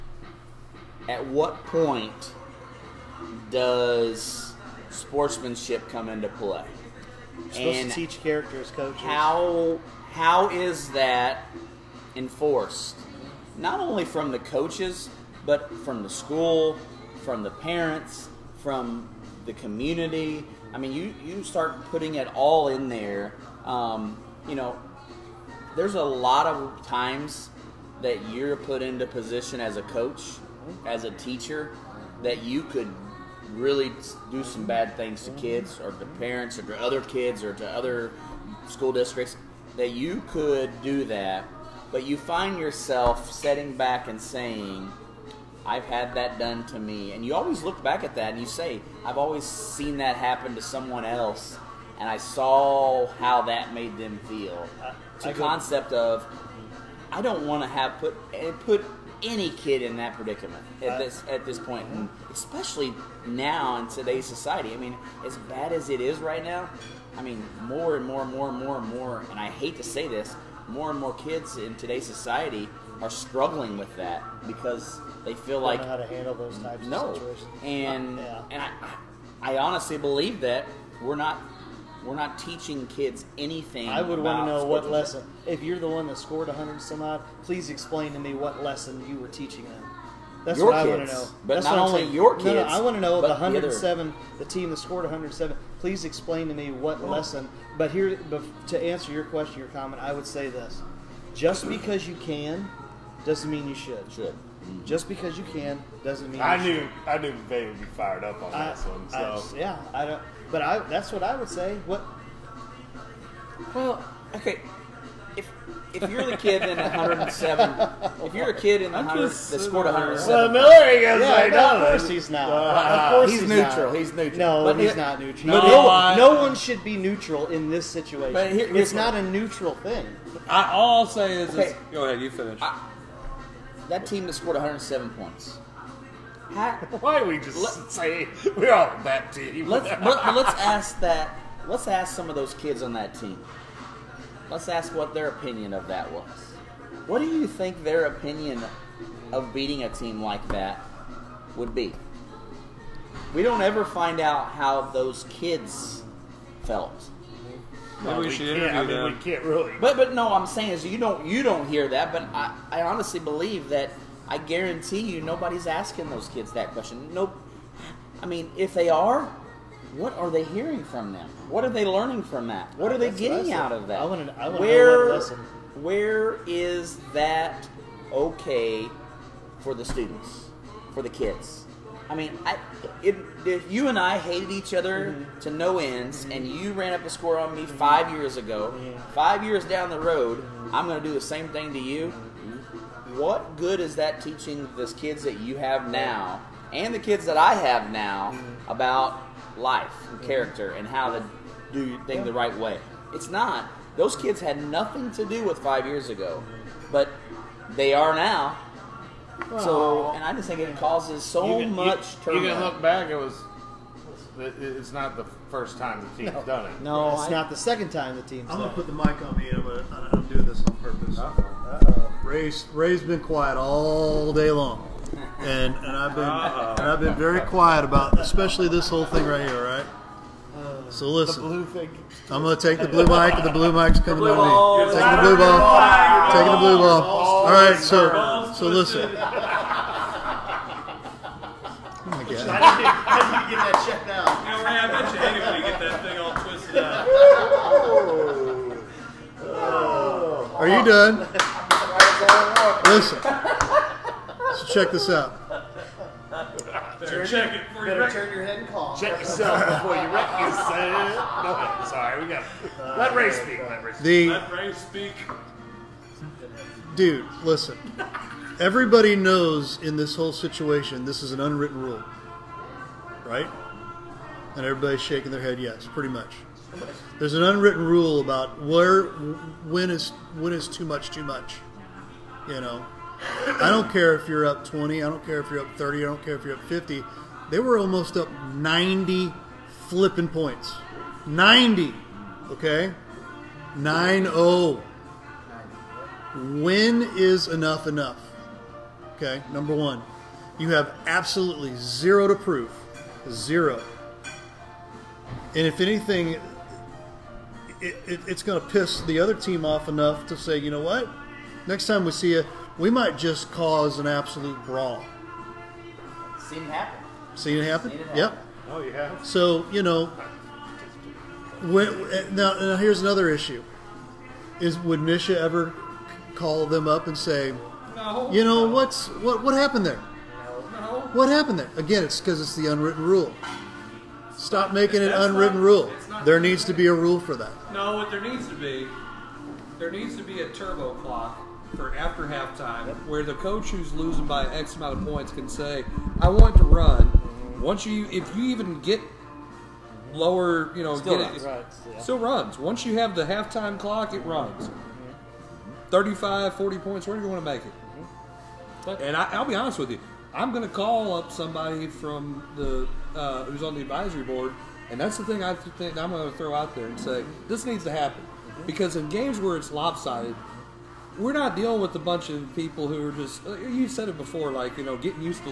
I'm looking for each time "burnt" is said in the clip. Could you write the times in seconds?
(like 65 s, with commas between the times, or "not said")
not said.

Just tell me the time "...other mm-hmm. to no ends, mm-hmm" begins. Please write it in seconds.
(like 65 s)
184 s.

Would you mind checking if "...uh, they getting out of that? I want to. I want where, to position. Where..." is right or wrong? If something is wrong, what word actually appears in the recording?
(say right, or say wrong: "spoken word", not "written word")
wrong: "lesson", not "position".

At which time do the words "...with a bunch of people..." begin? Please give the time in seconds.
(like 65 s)
371 s.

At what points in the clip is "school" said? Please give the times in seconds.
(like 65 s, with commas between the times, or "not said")
16 s, 38 s.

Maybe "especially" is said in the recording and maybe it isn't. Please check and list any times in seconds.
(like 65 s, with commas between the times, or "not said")
62 s, 228 s.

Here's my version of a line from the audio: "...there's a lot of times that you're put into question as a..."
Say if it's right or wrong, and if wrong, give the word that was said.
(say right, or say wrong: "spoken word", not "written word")
wrong: "position", not "question".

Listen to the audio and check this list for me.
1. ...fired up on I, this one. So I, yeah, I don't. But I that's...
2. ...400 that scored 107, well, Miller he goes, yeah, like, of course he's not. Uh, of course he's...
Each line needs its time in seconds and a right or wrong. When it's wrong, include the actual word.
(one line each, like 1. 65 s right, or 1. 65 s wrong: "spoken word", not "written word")
1. 107 s right
2. 118 s wrong: "100", not "400".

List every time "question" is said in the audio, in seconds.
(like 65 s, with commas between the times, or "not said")
99 s, 166 s.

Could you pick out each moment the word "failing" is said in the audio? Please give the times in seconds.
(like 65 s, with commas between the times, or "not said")
not said.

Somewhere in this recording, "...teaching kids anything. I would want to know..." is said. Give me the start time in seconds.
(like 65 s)
82 s.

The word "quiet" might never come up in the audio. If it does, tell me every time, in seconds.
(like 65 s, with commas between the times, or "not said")
223 s, 227 s.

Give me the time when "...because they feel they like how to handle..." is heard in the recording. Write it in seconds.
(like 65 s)
74 s.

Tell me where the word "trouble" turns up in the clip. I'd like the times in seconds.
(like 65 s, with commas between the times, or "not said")
212 s.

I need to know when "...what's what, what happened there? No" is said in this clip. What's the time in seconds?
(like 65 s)
328 s.